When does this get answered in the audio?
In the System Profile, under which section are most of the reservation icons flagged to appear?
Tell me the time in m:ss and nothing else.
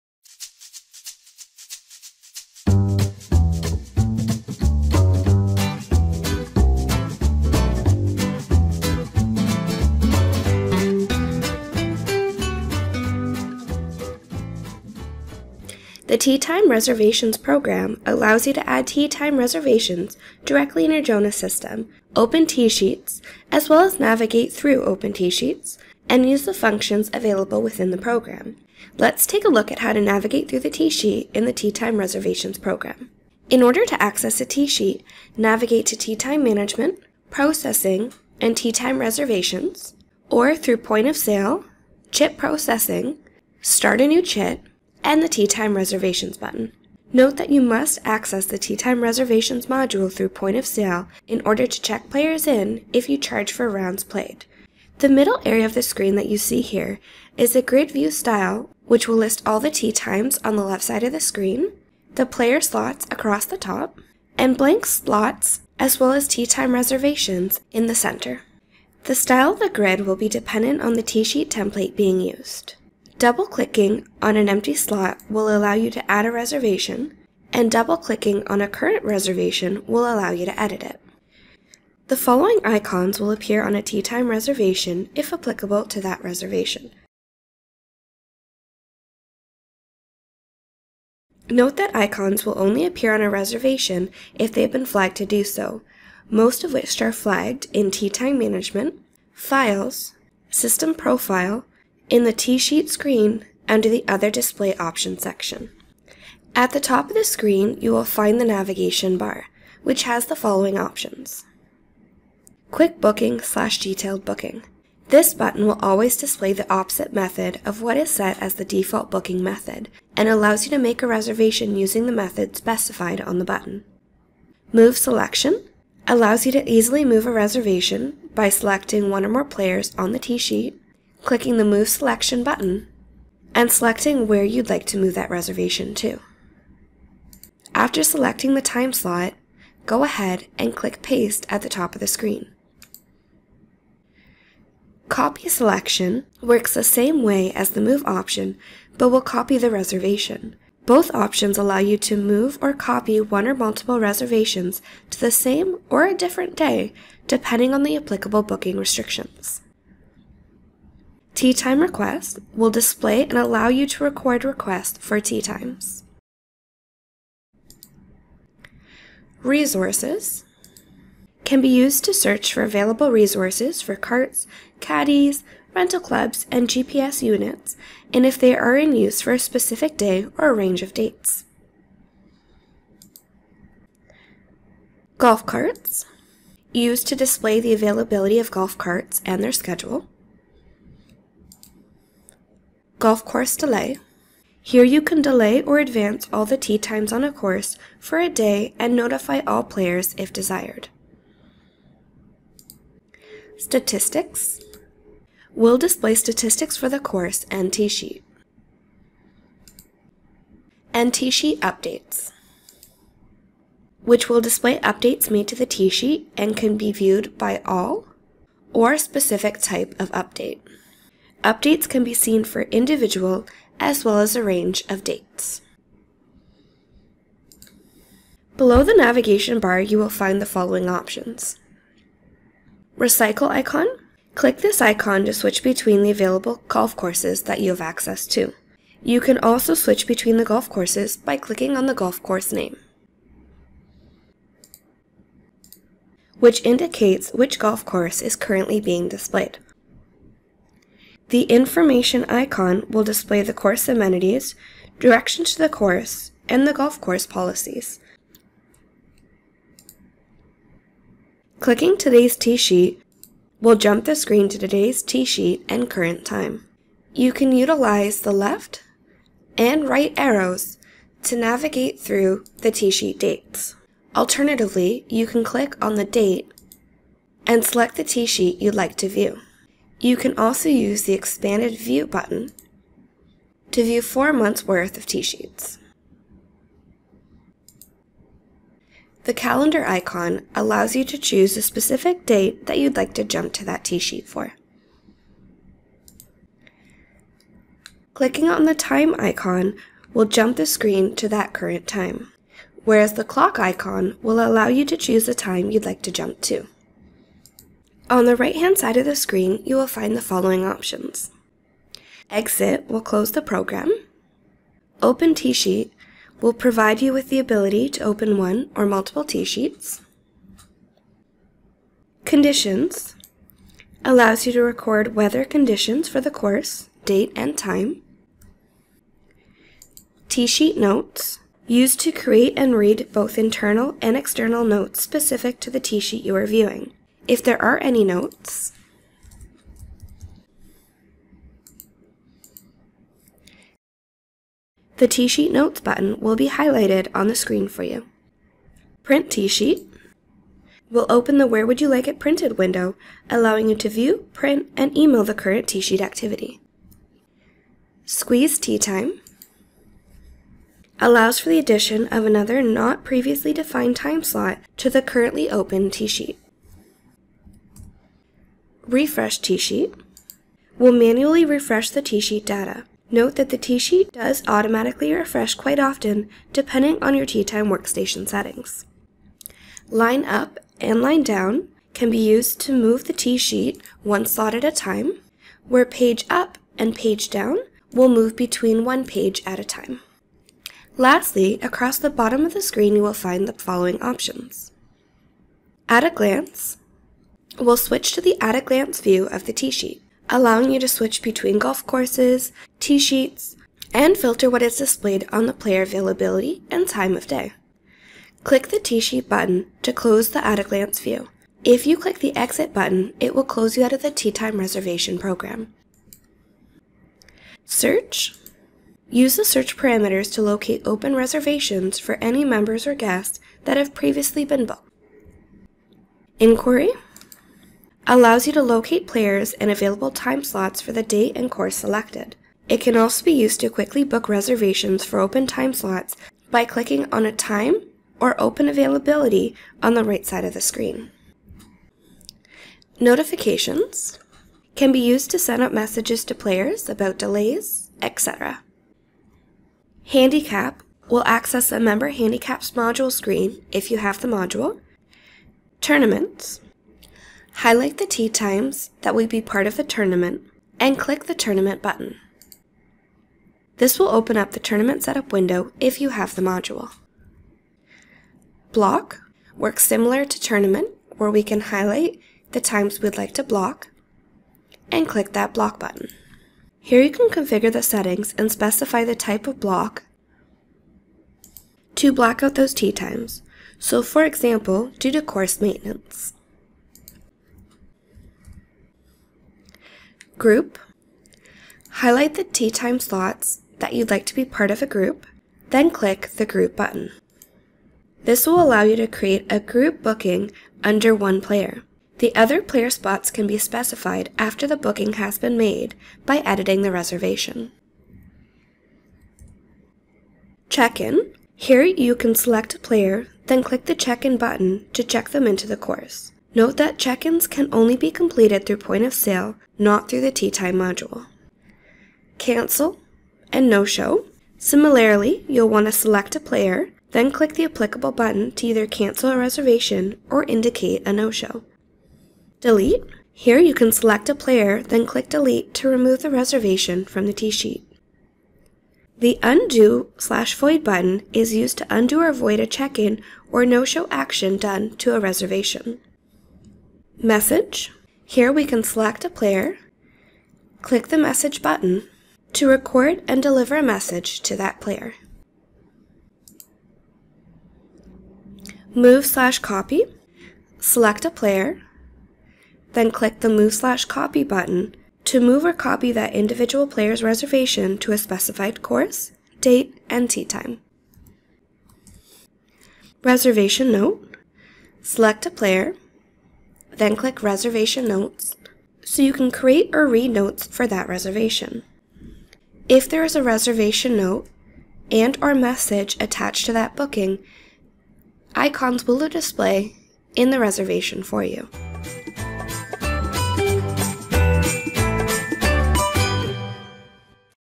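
1:44.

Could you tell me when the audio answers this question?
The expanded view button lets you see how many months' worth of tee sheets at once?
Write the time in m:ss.
4:44.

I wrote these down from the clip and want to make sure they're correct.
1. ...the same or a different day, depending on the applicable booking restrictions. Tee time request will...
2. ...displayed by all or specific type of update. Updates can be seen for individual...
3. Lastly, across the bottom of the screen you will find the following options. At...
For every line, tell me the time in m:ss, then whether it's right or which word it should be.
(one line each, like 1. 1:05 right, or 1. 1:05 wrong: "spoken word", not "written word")
1. 2:35 right
2. 3:36 wrong: "viewed", not "displayed"
3. 6:30 right.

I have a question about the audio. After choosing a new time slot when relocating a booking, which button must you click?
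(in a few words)
Paste.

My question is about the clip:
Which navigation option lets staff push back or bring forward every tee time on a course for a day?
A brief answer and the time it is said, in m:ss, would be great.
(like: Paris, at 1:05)
Golf Course Delay, at 3:13.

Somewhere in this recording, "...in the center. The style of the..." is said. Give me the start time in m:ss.
1:07.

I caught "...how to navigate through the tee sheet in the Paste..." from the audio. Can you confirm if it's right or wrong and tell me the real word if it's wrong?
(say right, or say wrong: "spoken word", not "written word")
wrong: "Tee", not "Paste".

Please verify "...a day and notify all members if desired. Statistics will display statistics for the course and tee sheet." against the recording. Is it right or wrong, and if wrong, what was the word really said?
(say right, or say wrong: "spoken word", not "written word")
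wrong: "players", not "members".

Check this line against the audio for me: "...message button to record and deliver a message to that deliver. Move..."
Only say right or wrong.
wrong.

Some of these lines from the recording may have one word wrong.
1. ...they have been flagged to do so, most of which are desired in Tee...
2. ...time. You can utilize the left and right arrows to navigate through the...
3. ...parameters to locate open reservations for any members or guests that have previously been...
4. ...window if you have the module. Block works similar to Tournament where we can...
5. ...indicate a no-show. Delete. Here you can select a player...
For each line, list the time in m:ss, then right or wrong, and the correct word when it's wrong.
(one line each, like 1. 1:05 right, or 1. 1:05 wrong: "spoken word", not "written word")
1. 1:34 wrong: "flagged", not "desired"
2. 4:26 right
3. 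6:59 right
4. 7:45 right
5. 8:50 right.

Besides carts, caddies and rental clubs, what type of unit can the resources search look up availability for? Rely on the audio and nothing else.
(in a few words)
GPS units.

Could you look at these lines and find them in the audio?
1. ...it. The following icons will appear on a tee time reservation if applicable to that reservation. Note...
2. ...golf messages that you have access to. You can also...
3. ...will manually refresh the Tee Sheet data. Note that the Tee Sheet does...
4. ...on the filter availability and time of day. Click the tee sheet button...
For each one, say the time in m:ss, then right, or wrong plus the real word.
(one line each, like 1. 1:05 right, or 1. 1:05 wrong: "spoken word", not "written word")
1. 1:20 right
2. 3:56 wrong: "courses", not "messages"
3. 6:10 right
4. 6:45 wrong: "player", not "filter".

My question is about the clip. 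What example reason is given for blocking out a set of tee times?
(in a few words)
Course maintenance.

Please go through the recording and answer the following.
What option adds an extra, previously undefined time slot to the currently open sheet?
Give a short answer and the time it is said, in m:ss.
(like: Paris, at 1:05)
Squeeze Tee Time, at 5:58.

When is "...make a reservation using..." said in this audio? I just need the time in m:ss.
2:00.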